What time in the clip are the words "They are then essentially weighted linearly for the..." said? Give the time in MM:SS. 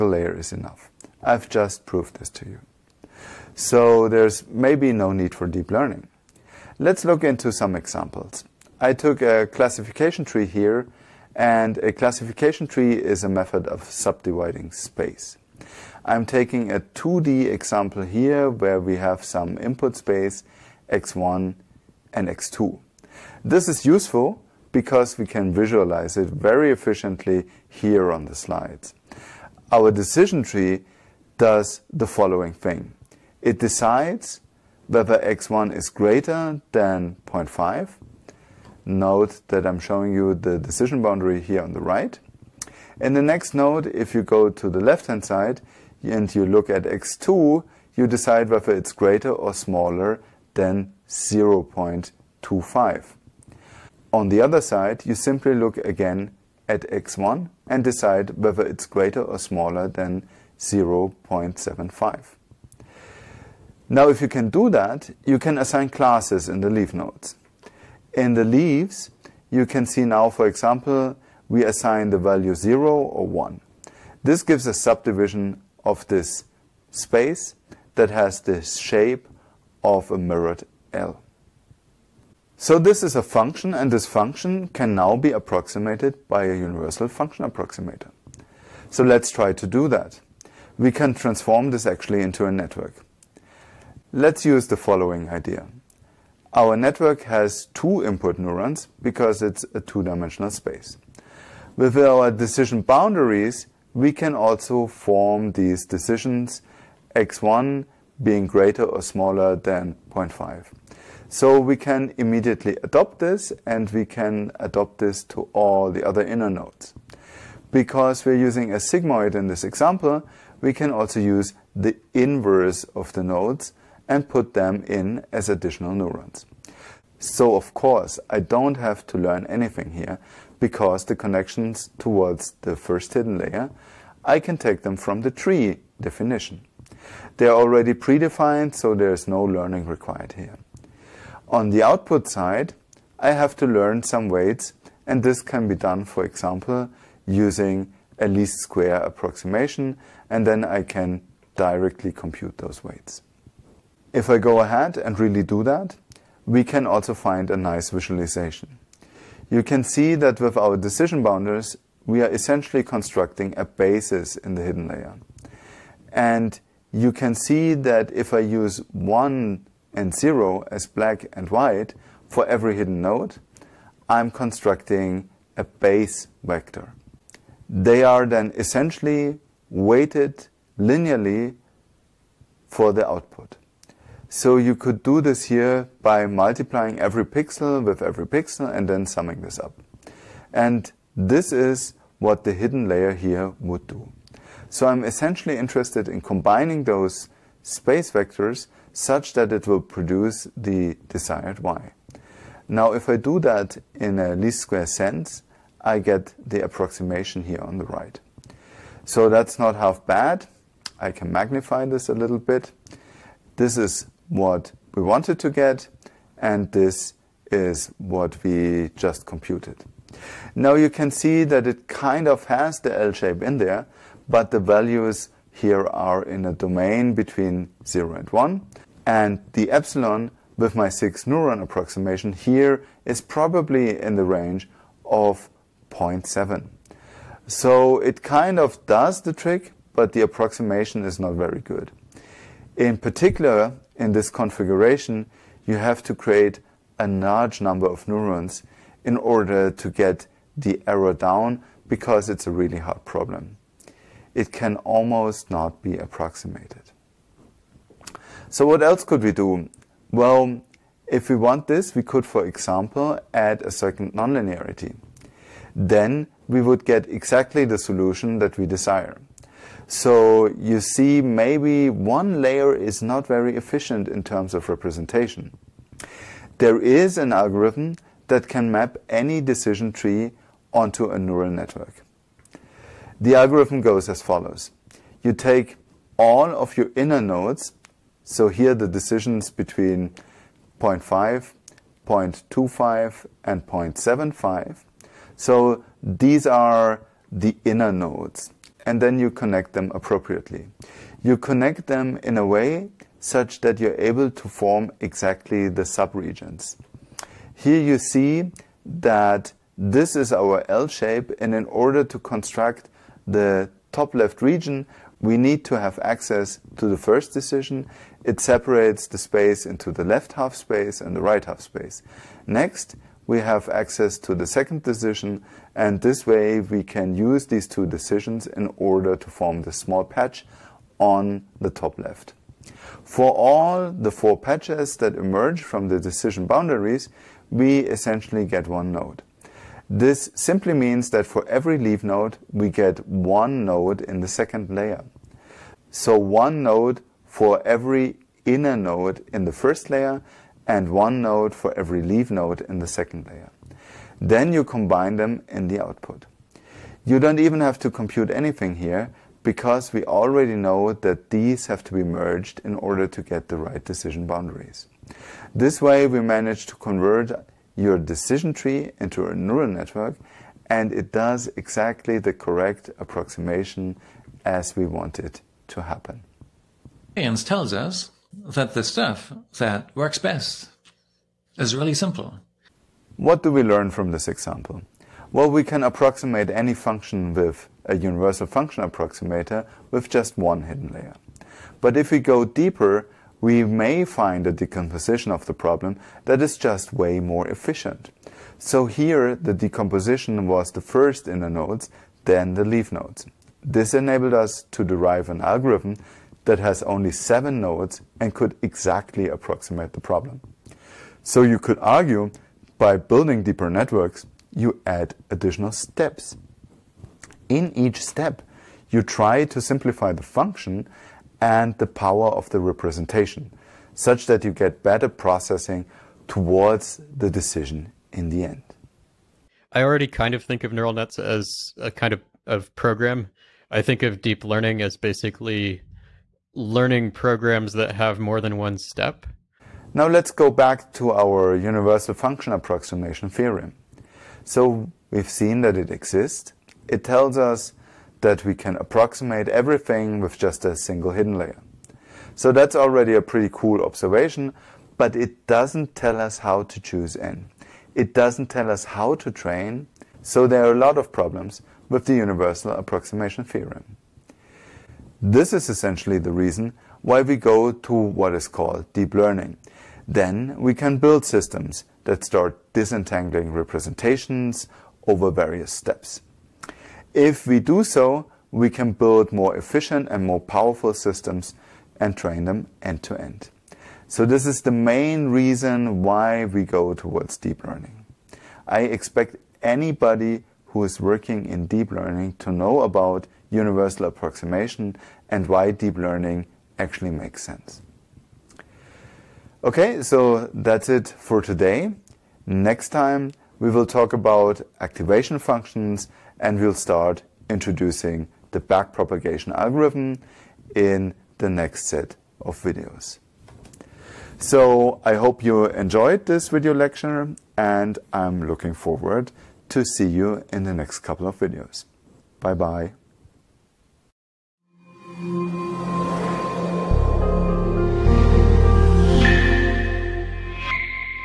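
02:57.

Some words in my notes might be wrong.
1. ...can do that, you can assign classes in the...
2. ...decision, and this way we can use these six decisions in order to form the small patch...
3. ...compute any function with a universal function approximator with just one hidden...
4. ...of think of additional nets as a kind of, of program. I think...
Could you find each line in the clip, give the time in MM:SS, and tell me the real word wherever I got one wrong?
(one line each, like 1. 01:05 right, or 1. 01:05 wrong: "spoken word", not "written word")
1. 01:04 right
2. 05:24 wrong: "two", not "six"
3. 06:25 wrong: "approximate", not "compute"
4. 07:10 wrong: "neural", not "additional".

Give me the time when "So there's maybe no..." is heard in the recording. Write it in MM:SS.
00:03.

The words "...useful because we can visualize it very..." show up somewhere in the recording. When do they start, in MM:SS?
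00:23.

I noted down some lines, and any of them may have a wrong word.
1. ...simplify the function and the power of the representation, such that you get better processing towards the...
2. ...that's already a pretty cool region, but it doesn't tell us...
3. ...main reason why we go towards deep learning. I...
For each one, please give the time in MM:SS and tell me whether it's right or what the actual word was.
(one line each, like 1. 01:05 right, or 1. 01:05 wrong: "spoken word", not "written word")
1. 06:59 right
2. 07:32 wrong: "observation", not "region"
3. 08:04 right.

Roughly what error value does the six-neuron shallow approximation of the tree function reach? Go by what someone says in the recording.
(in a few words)
0.7.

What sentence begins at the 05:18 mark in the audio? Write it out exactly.
It separates the space into the left half space and the right half space.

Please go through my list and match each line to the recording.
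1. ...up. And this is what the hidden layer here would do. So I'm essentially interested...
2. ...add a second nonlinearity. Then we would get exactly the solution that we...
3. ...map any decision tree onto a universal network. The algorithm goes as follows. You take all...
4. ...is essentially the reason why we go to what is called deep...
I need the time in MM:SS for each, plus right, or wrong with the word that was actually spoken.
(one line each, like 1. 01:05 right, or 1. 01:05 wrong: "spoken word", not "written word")
1. 03:09 right
2. 04:23 right
3. 04:38 wrong: "neural", not "universal"
4. 07:45 right.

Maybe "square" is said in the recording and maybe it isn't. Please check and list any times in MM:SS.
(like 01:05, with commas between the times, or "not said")
02:28, 03:24.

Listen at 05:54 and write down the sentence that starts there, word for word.
Then you combine them in the output.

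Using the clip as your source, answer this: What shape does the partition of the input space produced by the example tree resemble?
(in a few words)
A mirrored L.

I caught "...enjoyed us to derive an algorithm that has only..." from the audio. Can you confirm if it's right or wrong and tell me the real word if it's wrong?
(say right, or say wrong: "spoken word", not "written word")
wrong: "enabled", not "enjoyed".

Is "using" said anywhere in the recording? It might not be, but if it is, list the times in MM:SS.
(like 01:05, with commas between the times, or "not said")
01:58, 02:27.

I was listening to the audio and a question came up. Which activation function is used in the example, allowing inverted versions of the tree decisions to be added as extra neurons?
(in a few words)
Sigmoid.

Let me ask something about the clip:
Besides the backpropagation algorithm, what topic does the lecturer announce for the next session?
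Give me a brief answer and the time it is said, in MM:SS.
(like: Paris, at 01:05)
Activation functions, at 08:24.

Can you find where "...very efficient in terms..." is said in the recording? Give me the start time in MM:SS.
04:33.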